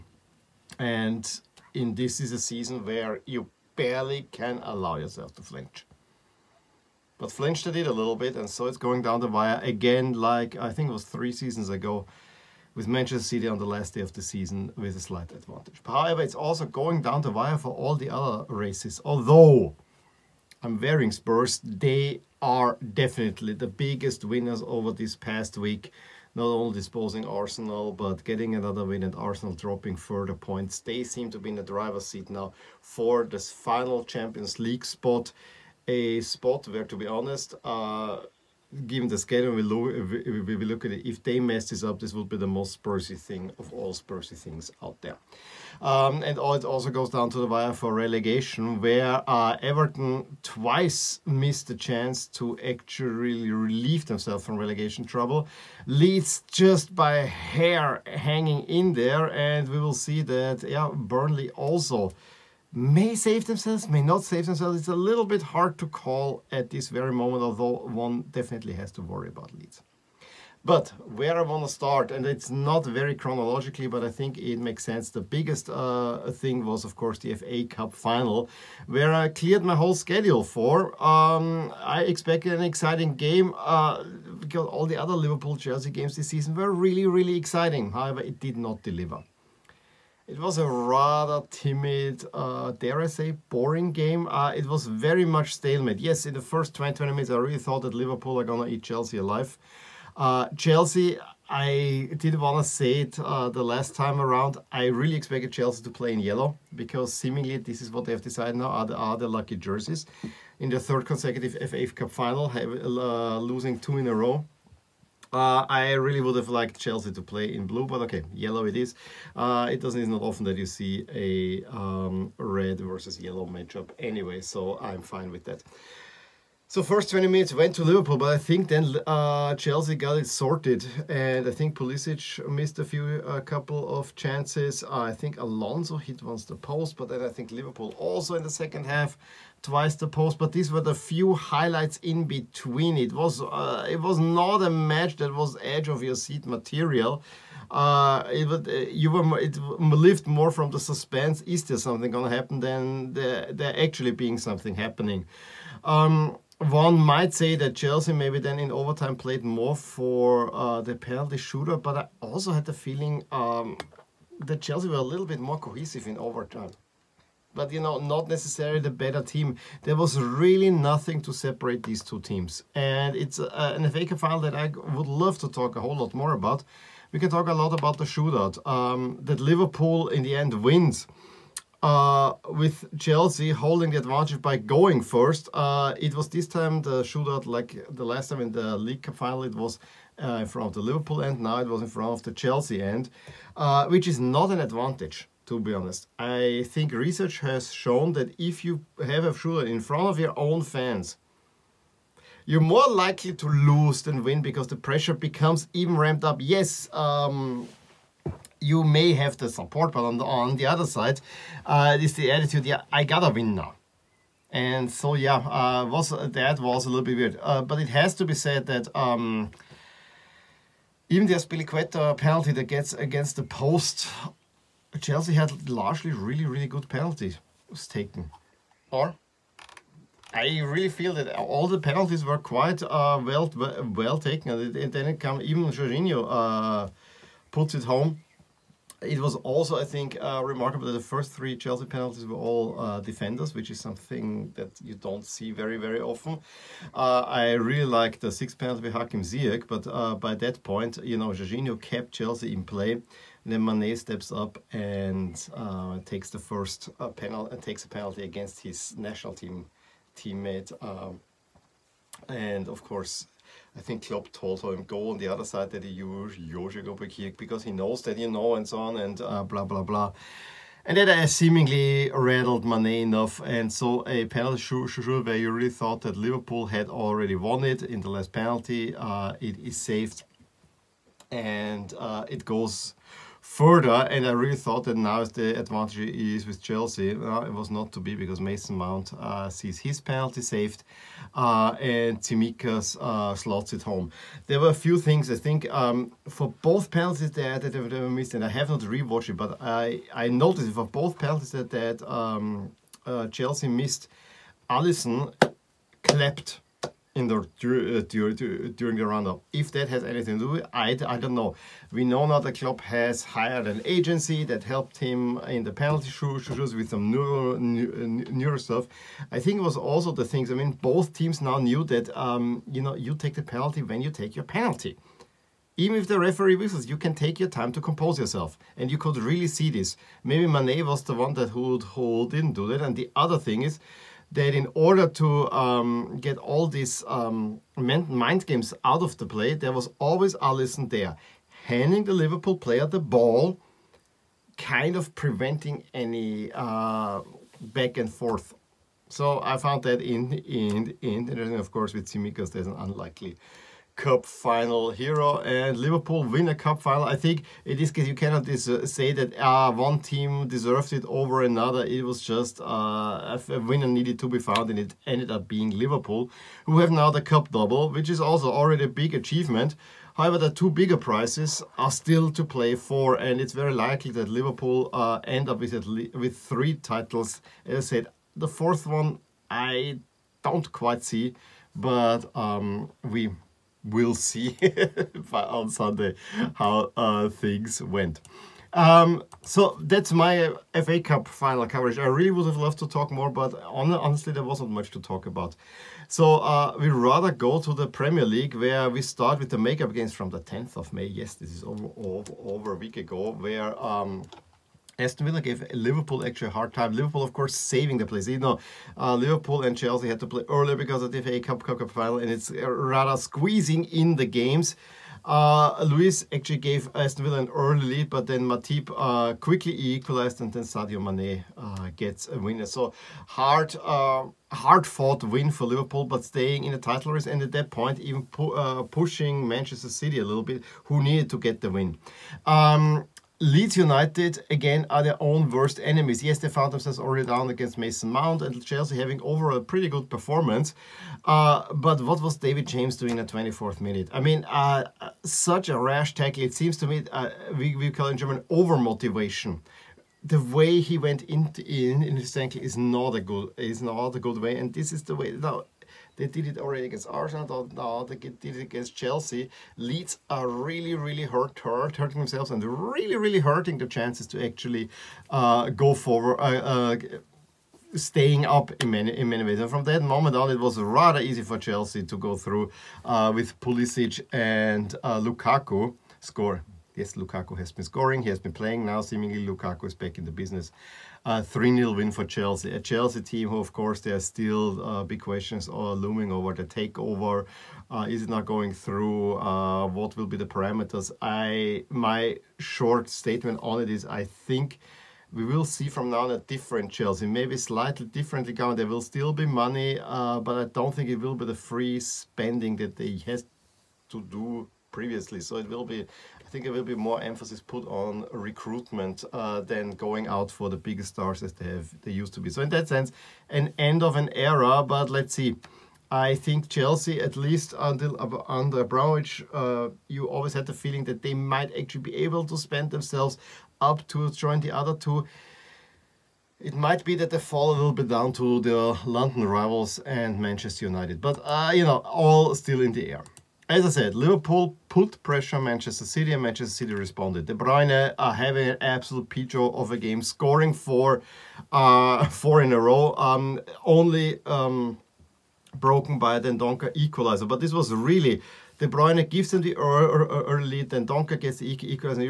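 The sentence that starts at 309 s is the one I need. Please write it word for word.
If that has anything to do with it, I, I don't know.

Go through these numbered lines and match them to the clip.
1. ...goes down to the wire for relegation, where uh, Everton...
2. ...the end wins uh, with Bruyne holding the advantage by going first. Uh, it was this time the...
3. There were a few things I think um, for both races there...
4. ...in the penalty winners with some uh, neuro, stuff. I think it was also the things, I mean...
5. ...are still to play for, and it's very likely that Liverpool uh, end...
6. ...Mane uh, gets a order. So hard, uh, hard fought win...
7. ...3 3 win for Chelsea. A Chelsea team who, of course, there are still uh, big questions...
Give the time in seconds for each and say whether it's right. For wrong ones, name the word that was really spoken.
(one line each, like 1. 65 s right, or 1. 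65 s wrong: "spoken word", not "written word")
1. 46 s right
2. 180 s wrong: "Chelsea", not "Bruyne"
3. 294 s wrong: "penalties", not "races"
4. 315 s wrong: "shooters", not "winners"
5. 371 s right
6. 421 s wrong: "winner", not "order"
7. 481 s wrong: "0", not "3".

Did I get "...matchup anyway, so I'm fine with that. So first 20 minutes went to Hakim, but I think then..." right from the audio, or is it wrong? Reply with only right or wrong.
wrong.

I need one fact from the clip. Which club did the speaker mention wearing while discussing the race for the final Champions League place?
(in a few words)
Spurs.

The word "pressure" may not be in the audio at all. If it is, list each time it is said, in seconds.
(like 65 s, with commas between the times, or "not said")
204 s, 535 s.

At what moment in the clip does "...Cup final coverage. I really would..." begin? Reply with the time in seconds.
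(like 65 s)
390 s.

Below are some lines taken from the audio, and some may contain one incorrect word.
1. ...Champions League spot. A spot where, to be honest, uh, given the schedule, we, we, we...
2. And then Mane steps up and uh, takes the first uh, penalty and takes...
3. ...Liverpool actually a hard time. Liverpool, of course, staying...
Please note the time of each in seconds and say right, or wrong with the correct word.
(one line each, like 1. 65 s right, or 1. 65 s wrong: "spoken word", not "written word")
1. 34 s right
2. 252 s right
3. 405 s wrong: "saving", not "staying".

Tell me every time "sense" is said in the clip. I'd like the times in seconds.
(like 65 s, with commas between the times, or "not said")
74 s, 512 s.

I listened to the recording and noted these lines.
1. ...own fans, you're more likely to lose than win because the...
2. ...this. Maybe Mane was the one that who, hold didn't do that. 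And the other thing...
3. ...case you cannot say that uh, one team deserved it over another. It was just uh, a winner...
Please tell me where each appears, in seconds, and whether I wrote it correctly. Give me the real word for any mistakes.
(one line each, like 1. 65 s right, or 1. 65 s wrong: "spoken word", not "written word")
1. 200 s right
2. 329 s right
3. 357 s right.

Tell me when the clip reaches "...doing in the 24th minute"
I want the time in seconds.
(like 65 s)
442 s.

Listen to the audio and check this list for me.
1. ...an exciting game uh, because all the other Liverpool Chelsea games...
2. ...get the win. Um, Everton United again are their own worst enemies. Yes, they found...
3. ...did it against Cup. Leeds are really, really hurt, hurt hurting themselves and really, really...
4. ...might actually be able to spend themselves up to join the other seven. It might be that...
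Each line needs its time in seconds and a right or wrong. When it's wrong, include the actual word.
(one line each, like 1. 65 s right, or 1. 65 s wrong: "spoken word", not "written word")
1. 82 s right
2. 431 s wrong: "Leeds", not "Everton"
3. 458 s wrong: "Chelsea", not "Cup"
4. 521 s wrong: "two", not "seven".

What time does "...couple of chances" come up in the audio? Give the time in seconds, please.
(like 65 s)
133 s.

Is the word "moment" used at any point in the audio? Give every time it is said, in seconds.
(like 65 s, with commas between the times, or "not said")
67 s, 470 s.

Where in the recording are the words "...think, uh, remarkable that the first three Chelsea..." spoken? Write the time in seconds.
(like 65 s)
239 s.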